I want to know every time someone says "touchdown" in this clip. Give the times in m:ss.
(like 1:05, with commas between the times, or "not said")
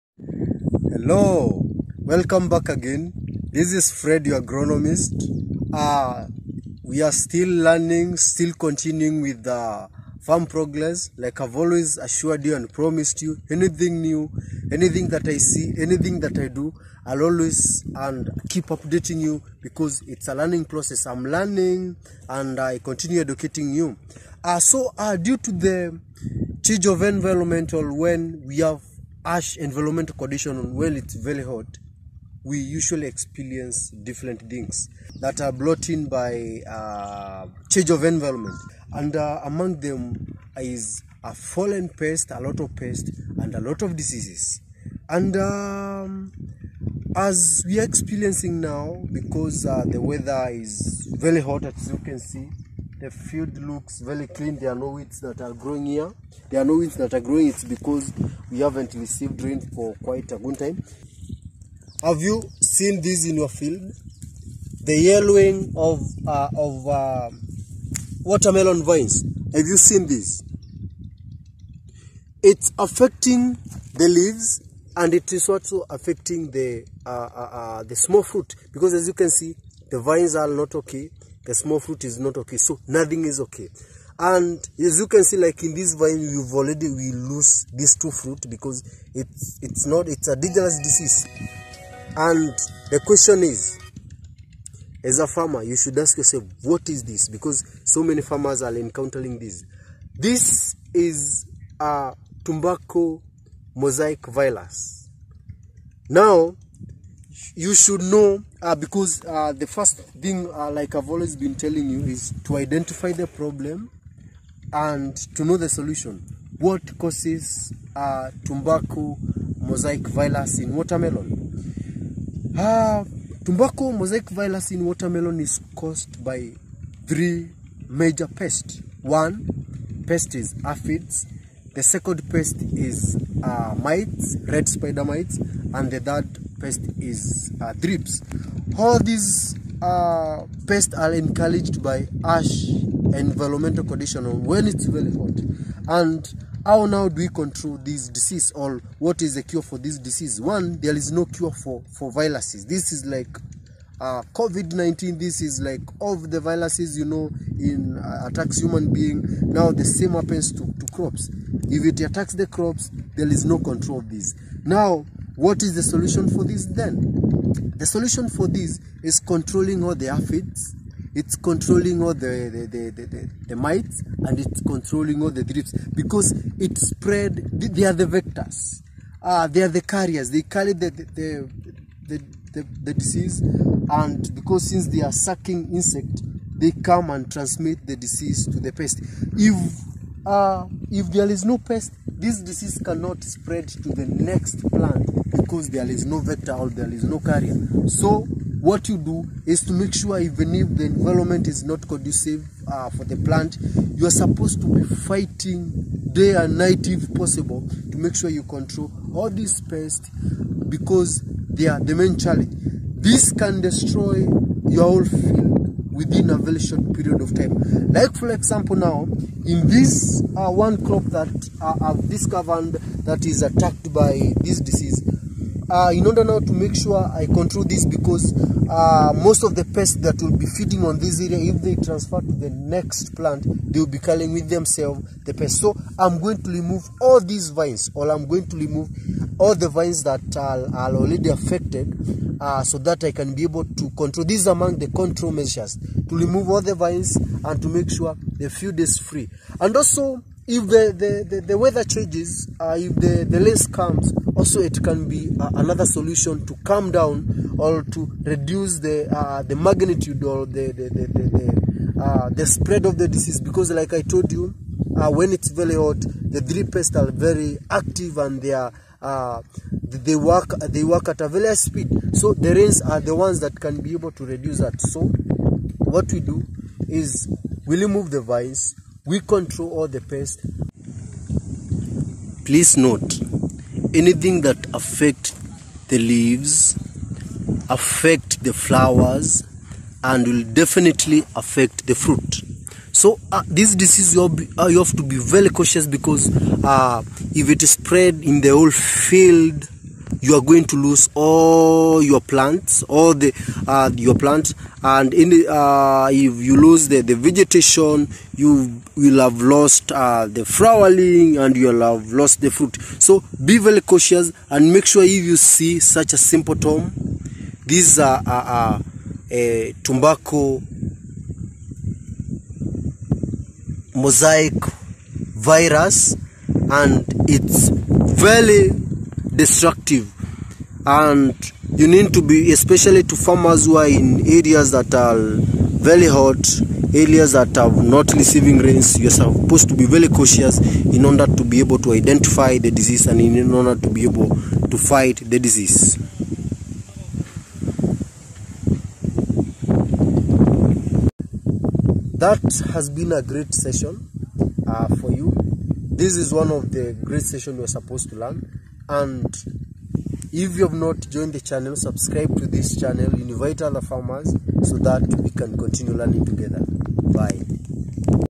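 not said.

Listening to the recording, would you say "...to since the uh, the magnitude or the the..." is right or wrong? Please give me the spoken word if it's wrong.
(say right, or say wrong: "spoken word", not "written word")
wrong: "reduce", not "since".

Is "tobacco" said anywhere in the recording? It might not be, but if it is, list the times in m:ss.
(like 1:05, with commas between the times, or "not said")
1:42, 1:58, 2:03, 5:19.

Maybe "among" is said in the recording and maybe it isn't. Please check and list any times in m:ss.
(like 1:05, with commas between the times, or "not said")
0:39, 4:04.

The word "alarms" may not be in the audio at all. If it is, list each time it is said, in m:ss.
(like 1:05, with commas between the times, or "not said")
not said.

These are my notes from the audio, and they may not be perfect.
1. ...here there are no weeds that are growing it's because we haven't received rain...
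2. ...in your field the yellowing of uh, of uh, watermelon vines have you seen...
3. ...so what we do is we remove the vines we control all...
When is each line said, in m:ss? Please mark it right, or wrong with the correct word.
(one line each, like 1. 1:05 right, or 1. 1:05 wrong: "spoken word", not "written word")
1. 0:55 right
2. 1:03 right
3. 4:34 right.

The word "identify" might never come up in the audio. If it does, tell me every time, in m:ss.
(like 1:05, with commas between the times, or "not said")
1:52, 5:41.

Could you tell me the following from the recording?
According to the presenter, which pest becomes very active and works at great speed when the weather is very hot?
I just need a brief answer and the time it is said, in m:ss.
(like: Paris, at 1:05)
Thrips, at 4:26.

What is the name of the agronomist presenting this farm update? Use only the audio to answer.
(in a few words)
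Fred.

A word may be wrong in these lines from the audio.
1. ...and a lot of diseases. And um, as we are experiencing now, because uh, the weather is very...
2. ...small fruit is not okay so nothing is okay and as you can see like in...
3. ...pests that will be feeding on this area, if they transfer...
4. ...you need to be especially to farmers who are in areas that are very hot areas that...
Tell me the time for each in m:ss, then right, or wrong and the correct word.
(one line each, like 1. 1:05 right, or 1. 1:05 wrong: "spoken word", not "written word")
1. 0:43 right
2. 1:21 right
3. 3:49 right
4. 5:31 right.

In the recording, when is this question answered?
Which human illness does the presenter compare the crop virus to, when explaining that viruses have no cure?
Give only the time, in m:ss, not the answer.
2:34.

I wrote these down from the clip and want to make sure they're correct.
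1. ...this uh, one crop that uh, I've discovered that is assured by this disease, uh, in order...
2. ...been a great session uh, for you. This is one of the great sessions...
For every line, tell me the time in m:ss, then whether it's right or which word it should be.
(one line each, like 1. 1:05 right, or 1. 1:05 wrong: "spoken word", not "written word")
1. 3:39 wrong: "attacked", not "assured"
2. 5:52 right.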